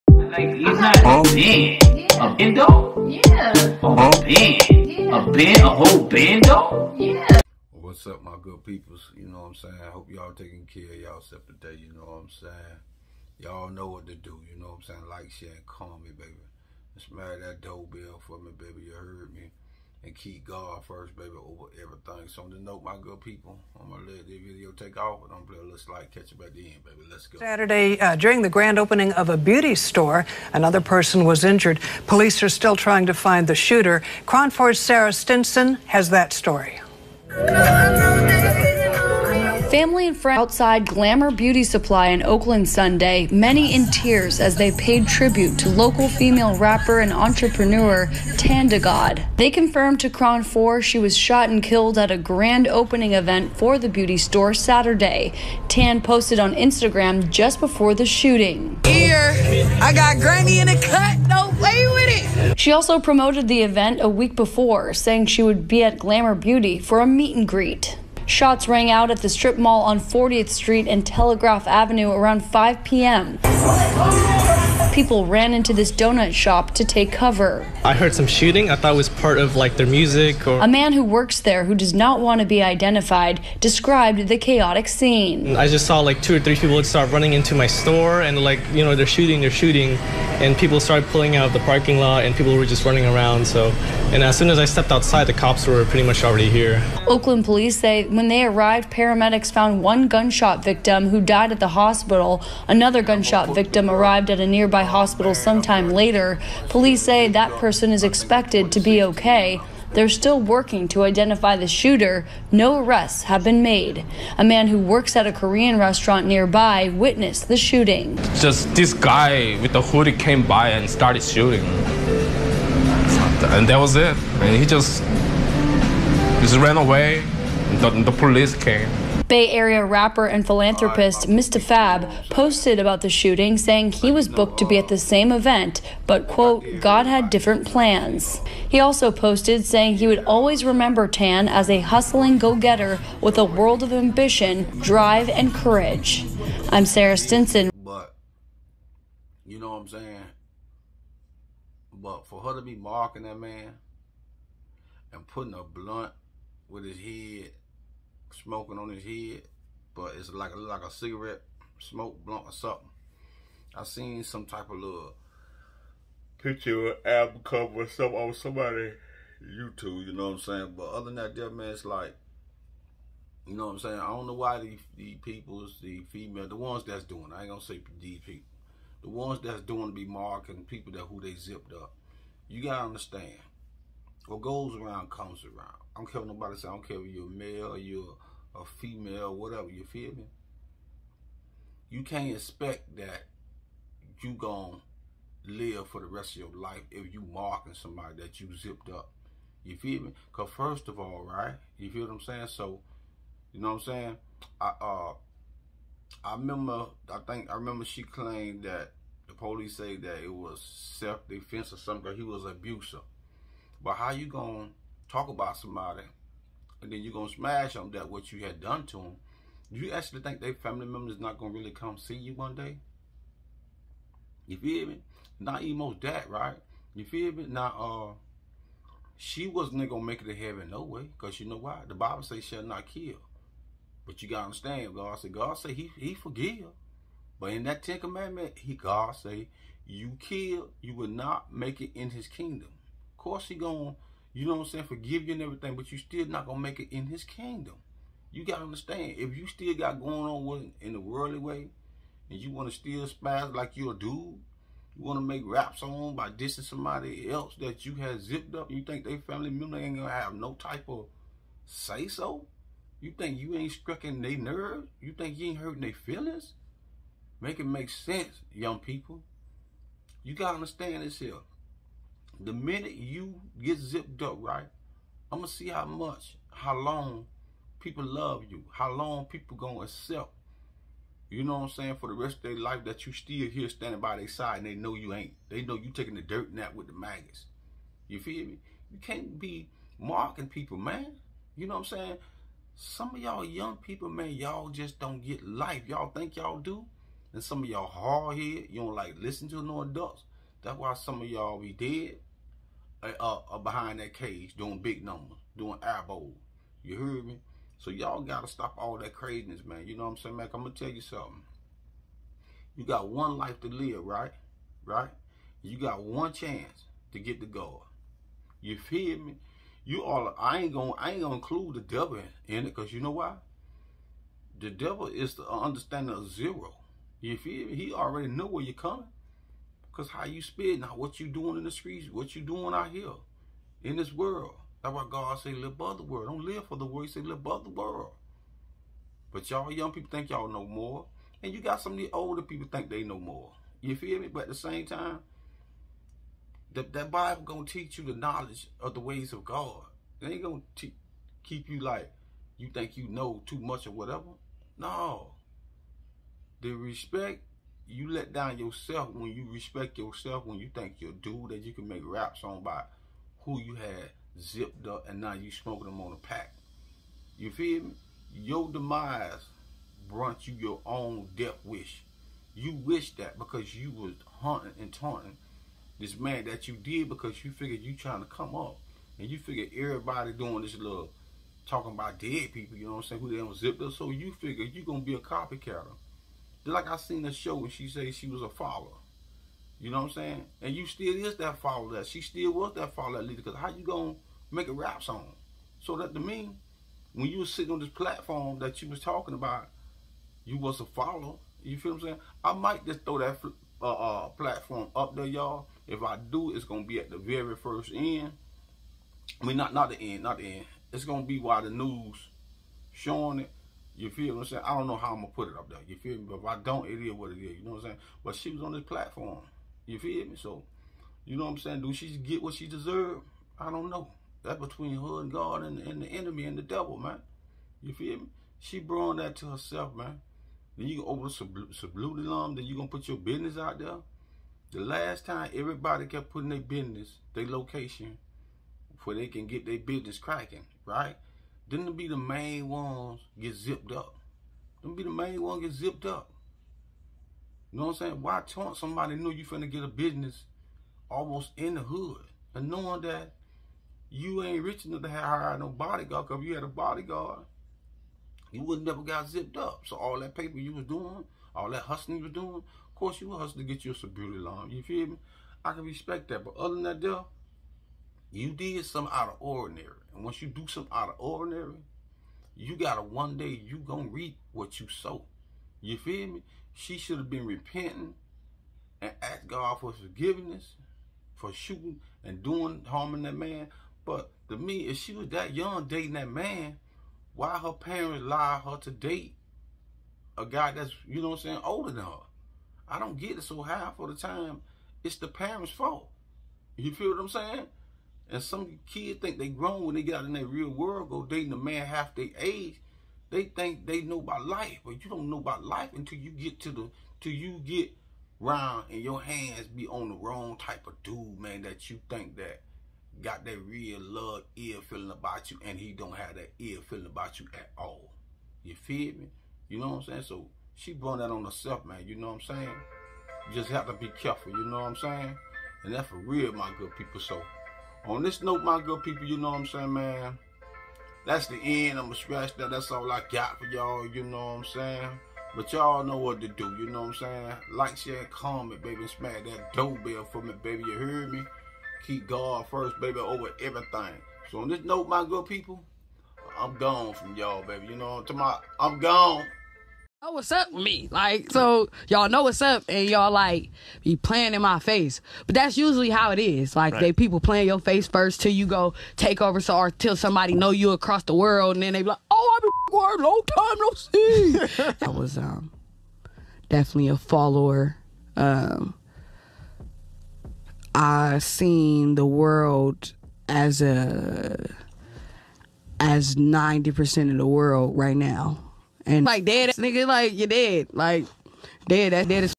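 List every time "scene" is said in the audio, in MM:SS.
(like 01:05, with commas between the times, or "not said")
01:24.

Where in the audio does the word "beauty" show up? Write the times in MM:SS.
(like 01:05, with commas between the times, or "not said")
00:29, 00:41, 00:53, 01:06.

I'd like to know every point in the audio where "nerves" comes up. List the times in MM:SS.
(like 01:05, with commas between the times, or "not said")
04:24.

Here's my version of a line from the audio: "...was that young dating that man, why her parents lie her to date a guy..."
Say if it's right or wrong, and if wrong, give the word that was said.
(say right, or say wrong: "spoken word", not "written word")
right.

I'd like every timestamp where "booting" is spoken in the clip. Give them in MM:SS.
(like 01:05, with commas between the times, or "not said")
not said.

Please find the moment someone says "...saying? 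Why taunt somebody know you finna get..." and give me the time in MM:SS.
07:27.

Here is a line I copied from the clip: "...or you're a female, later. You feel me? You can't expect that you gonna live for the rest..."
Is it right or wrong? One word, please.
wrong.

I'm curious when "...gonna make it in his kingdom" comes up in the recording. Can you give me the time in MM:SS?
04:06.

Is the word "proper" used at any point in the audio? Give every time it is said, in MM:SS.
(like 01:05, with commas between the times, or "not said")
not said.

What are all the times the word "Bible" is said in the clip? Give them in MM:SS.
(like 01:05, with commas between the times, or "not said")
03:51, 05:47.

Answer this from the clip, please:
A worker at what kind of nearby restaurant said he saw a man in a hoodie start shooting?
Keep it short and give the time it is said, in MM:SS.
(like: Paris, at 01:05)
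Korean restaurant, at 01:55.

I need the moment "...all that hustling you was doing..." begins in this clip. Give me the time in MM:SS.
07:41.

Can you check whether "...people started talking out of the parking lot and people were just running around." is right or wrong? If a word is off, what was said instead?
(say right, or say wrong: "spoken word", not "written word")
wrong: "pulling", not "talking".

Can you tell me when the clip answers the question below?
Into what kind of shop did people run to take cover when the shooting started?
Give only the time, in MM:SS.
01:15.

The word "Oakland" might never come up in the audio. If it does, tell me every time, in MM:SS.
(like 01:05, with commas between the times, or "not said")
00:42, 01:37.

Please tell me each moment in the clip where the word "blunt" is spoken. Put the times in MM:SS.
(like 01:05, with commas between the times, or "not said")
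02:35, 02:42.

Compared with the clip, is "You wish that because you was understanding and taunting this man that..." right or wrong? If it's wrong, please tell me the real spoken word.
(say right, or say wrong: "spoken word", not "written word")
wrong: "hunting", not "understanding".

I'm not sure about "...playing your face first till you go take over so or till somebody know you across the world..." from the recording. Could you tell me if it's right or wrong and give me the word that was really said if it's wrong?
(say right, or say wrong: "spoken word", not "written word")
right.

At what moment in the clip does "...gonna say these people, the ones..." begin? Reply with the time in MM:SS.
02:57.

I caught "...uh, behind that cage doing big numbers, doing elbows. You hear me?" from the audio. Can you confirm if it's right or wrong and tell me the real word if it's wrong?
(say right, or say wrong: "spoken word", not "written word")
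right.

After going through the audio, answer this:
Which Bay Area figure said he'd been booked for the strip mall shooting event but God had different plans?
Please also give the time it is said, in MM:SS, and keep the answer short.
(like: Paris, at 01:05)
Mr. Fab, at 02:11.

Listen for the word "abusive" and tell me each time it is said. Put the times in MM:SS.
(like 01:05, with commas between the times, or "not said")
03:32.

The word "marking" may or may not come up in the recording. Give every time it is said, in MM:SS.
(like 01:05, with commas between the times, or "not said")
02:32, 03:00, 03:17, 04:49.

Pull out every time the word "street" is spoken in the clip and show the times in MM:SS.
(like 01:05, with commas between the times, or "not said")
01:10, 05:31.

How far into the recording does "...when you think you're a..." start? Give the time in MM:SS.
06:00.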